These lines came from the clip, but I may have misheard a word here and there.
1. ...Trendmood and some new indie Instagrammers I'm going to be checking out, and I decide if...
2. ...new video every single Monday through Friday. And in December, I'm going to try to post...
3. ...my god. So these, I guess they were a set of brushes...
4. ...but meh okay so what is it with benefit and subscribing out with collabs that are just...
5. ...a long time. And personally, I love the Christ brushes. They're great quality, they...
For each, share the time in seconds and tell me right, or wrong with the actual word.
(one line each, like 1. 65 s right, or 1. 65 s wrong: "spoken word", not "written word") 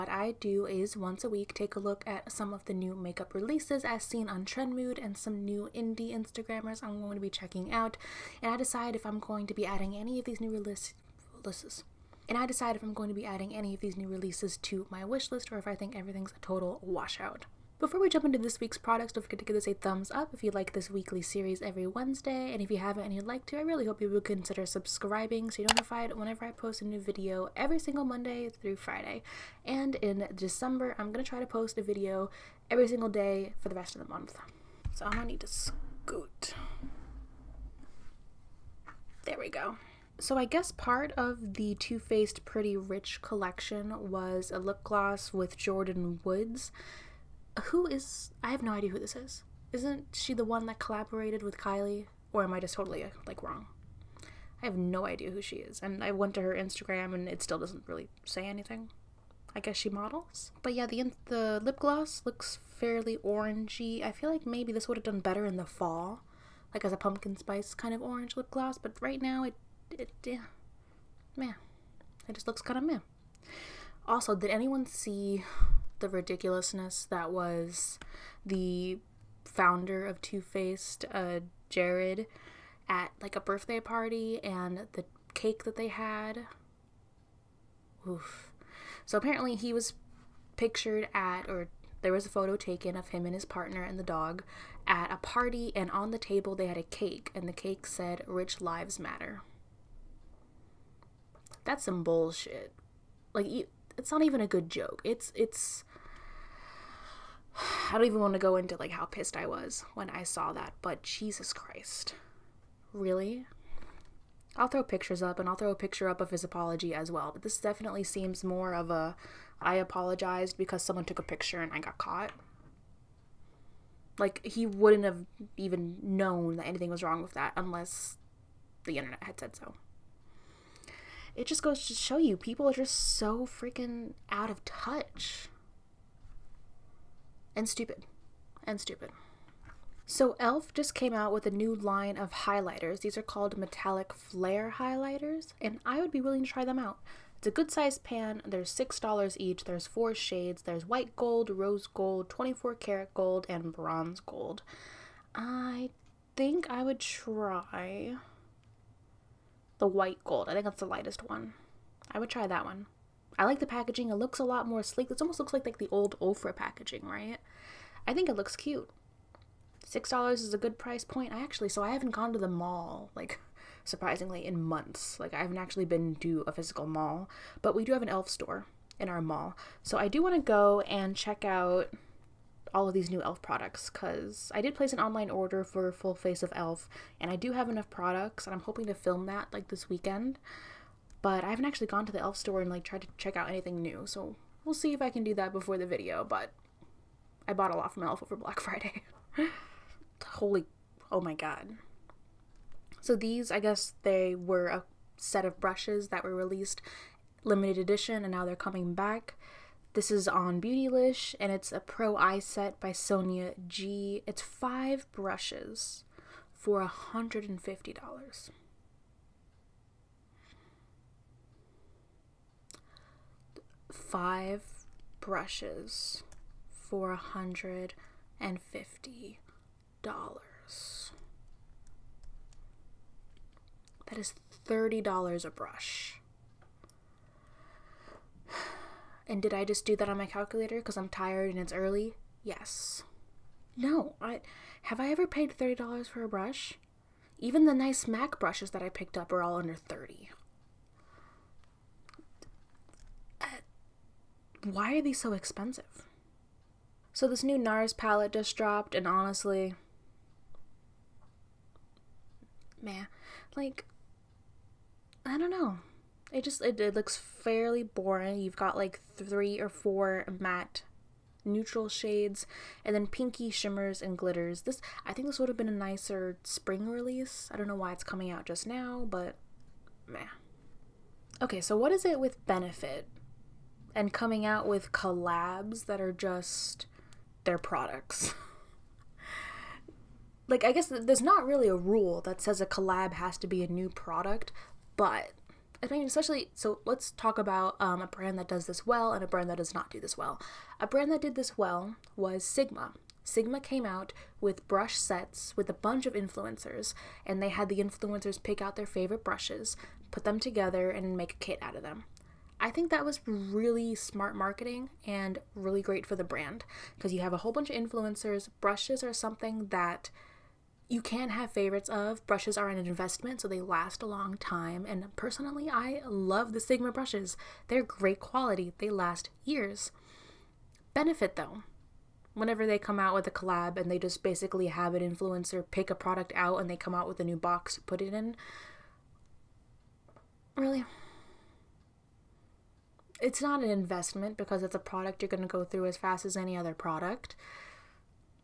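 1. 4 s right
2. 26 s right
3. 201 s right
4. 279 s wrong: "coming", not "subscribing"
5. 324 s wrong: "Sigma", not "Christ".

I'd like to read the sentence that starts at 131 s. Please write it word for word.
It just goes to show you people are just so freaking out of touch and stupid and stupid.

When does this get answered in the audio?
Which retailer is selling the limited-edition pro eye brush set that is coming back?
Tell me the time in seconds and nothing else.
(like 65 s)
210 s.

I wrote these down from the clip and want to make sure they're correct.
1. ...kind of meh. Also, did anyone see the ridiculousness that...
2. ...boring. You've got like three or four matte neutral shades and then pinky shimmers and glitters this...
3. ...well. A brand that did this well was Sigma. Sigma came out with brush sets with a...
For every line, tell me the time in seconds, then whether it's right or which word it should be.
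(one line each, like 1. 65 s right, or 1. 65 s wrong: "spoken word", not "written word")
1. 72 s right
2. 267 s right
3. 300 s right.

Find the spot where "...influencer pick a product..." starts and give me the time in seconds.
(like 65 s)
335 s.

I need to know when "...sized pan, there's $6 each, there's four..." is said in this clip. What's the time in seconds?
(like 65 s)
147 s.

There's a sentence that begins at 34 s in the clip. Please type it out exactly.
So I'm going to need to scoot.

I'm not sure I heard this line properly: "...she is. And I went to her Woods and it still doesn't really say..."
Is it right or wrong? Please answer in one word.
wrong.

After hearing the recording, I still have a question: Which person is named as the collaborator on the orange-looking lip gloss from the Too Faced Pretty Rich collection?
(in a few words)
Jordyn Woods.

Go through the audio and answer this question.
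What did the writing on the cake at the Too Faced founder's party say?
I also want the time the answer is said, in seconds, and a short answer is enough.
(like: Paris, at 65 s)
Rich Lives Matter, at 98 s.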